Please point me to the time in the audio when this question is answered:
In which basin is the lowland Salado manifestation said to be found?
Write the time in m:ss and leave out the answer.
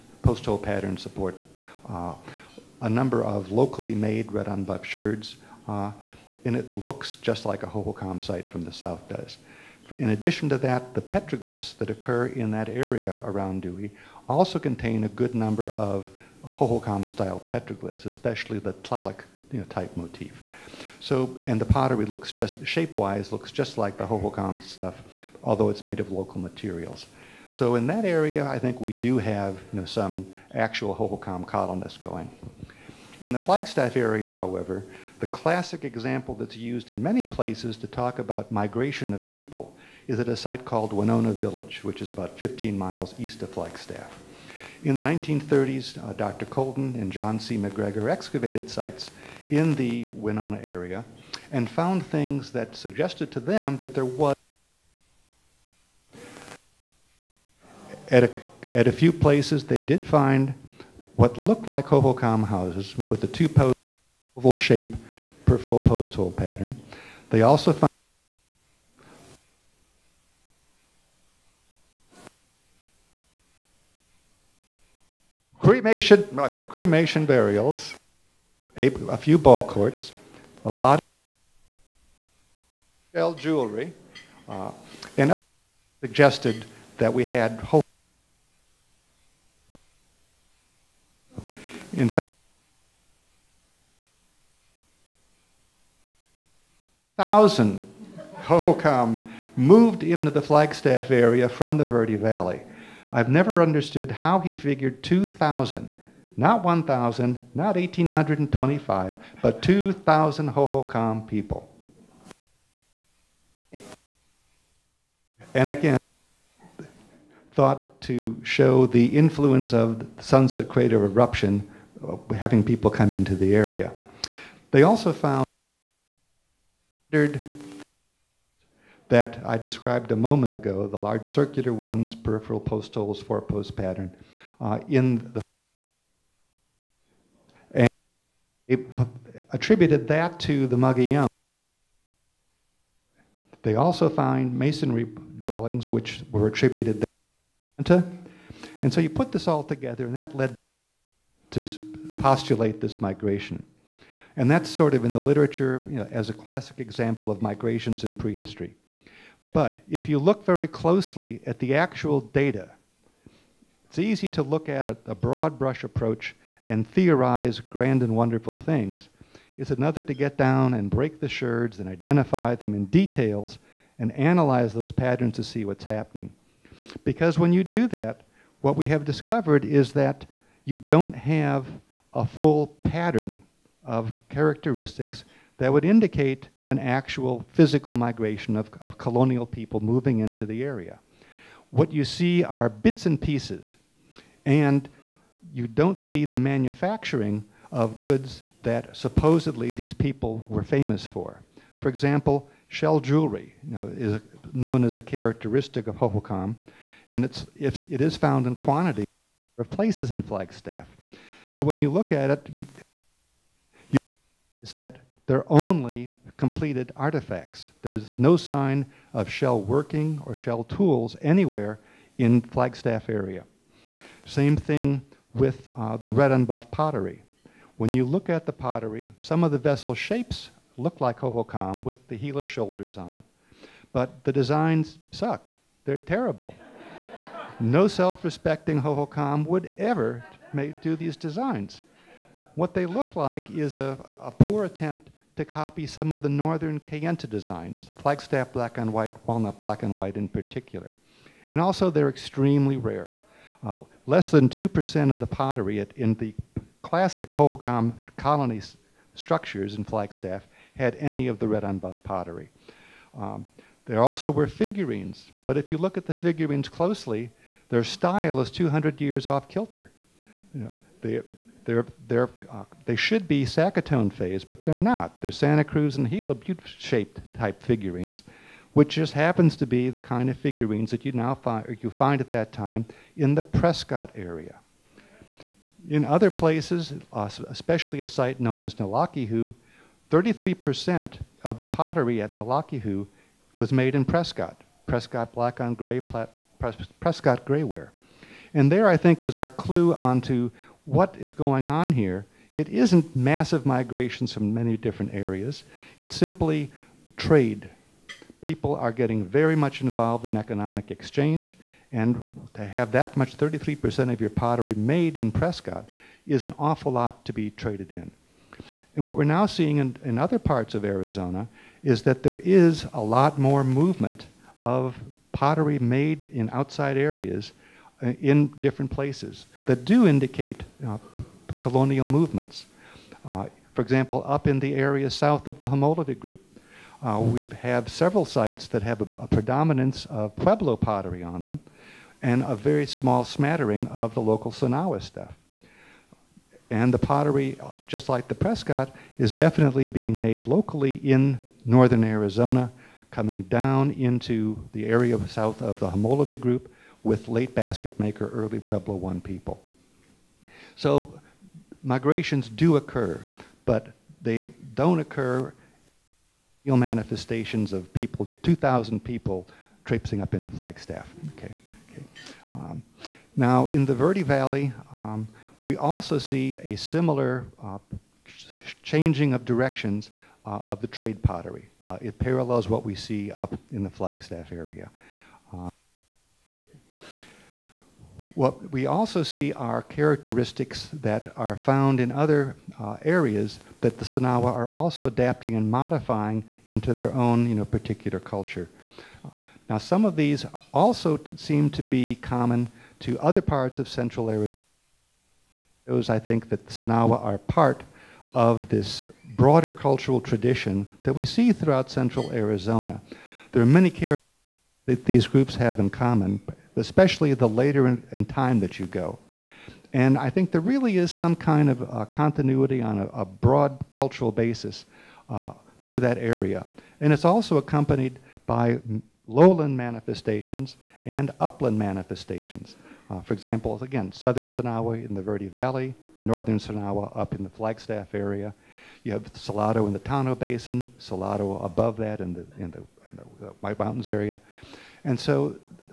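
7:19.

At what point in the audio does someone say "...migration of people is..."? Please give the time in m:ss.
0:38.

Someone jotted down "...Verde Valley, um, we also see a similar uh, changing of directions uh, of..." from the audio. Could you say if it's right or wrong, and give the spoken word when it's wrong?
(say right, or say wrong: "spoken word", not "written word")
right.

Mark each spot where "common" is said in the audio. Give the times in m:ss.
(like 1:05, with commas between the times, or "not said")
6:42, 6:55.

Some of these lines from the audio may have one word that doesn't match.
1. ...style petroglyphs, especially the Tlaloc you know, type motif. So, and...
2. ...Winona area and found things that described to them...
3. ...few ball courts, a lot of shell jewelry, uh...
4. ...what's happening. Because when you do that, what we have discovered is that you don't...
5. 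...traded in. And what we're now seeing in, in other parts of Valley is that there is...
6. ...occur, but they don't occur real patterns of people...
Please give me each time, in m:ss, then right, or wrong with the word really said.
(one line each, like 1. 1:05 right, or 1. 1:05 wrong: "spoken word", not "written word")
1. 0:17 right
2. 0:50 wrong: "suggested", not "described"
3. 1:19 right
4. 2:55 right
5. 5:17 wrong: "Arizona", not "Valley"
6. 6:02 wrong: "manifestations", not "patterns".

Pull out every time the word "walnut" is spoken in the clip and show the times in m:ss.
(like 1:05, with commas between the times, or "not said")
4:09.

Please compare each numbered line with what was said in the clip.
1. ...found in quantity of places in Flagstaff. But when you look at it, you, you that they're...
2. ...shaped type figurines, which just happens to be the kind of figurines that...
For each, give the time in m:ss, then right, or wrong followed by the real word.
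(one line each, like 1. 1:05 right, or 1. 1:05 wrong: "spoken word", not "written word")
1. 3:28 right
2. 4:36 right.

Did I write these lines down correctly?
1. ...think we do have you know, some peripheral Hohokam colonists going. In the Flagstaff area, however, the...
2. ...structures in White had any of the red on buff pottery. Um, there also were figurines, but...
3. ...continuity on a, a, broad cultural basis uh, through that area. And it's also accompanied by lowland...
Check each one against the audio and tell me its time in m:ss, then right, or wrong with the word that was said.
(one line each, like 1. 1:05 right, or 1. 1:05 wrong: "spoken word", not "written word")
1. 0:28 wrong: "actual", not "peripheral"
2. 4:19 wrong: "Flagstaff", not "White"
3. 7:02 right.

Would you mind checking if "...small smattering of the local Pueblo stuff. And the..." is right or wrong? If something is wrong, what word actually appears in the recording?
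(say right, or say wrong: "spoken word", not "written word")
wrong: "Sinagua", not "Pueblo".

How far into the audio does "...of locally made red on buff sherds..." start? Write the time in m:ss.
0:03.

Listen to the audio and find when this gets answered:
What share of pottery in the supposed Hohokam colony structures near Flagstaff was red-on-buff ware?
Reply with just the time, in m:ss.
4:14.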